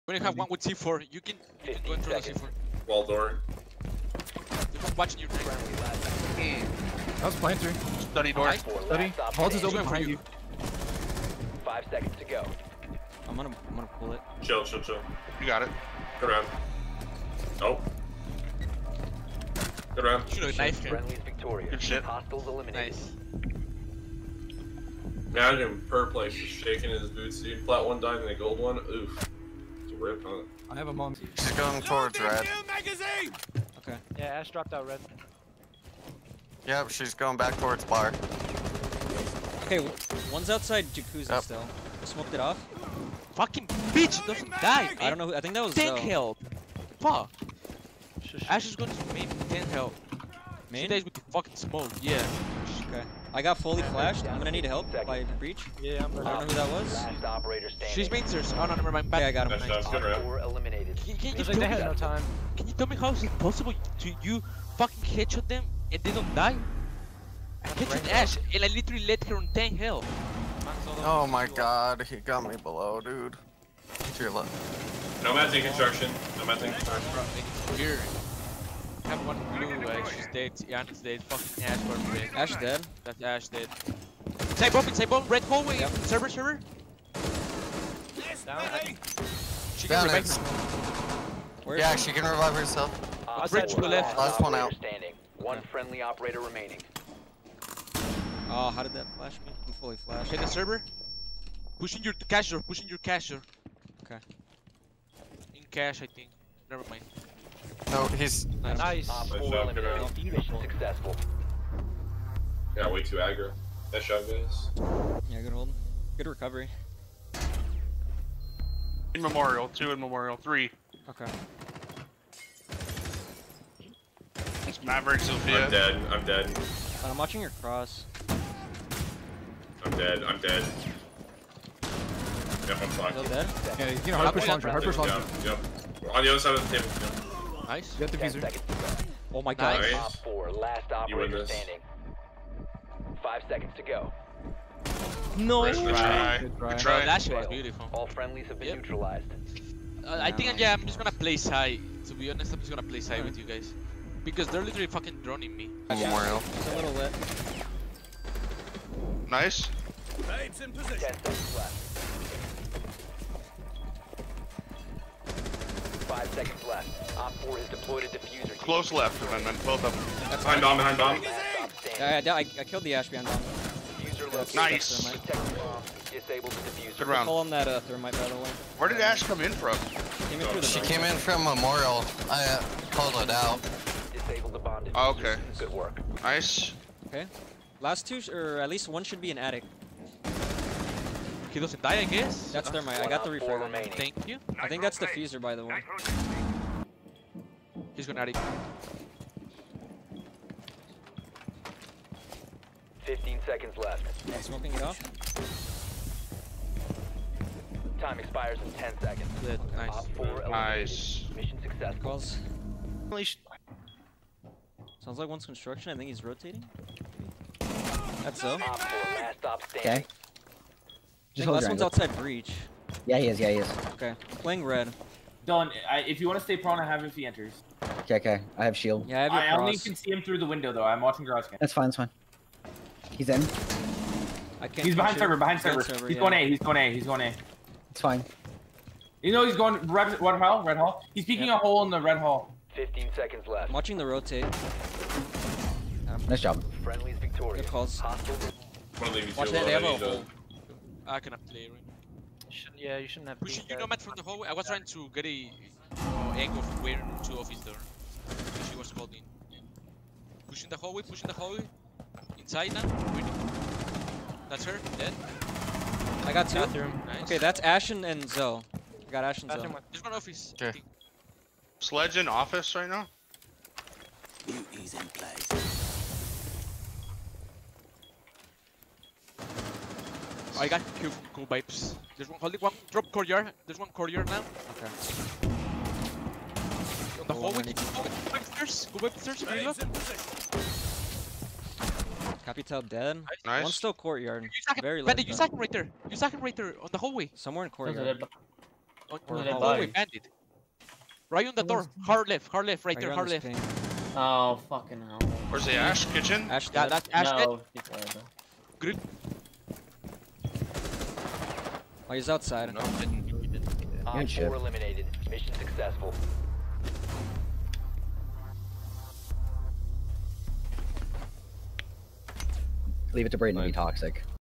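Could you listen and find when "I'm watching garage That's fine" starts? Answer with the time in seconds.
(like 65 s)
230 s.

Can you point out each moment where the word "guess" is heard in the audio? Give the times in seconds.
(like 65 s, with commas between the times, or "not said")
192 s.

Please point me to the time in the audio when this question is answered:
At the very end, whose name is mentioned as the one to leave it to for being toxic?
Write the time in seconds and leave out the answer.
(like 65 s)
323 s.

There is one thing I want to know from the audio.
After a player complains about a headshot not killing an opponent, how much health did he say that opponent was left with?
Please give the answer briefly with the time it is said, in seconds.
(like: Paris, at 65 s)
10, at 69 s.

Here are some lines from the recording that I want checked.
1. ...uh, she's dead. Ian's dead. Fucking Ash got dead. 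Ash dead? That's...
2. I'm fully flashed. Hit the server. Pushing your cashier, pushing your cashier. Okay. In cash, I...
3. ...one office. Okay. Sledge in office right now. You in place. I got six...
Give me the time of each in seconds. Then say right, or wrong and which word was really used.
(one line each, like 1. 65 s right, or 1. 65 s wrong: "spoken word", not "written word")
1. 79 s right
2. 99 s right
3. 270 s wrong: "two", not "six".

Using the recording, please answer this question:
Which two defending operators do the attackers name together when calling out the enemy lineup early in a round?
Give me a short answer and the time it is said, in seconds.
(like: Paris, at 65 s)
Maverick Zofia, at 124 s.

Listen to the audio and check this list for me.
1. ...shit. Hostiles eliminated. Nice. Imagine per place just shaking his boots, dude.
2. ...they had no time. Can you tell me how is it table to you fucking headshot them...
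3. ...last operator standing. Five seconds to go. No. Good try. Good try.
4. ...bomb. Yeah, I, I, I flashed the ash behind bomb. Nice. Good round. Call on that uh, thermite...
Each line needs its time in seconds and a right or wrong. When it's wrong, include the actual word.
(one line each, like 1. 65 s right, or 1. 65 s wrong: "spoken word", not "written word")
1. 21 s right
2. 61 s wrong: "possible", not "table"
3. 140 s right
4. 170 s wrong: "killed", not "flashed".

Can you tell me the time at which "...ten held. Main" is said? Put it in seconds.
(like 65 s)
49 s.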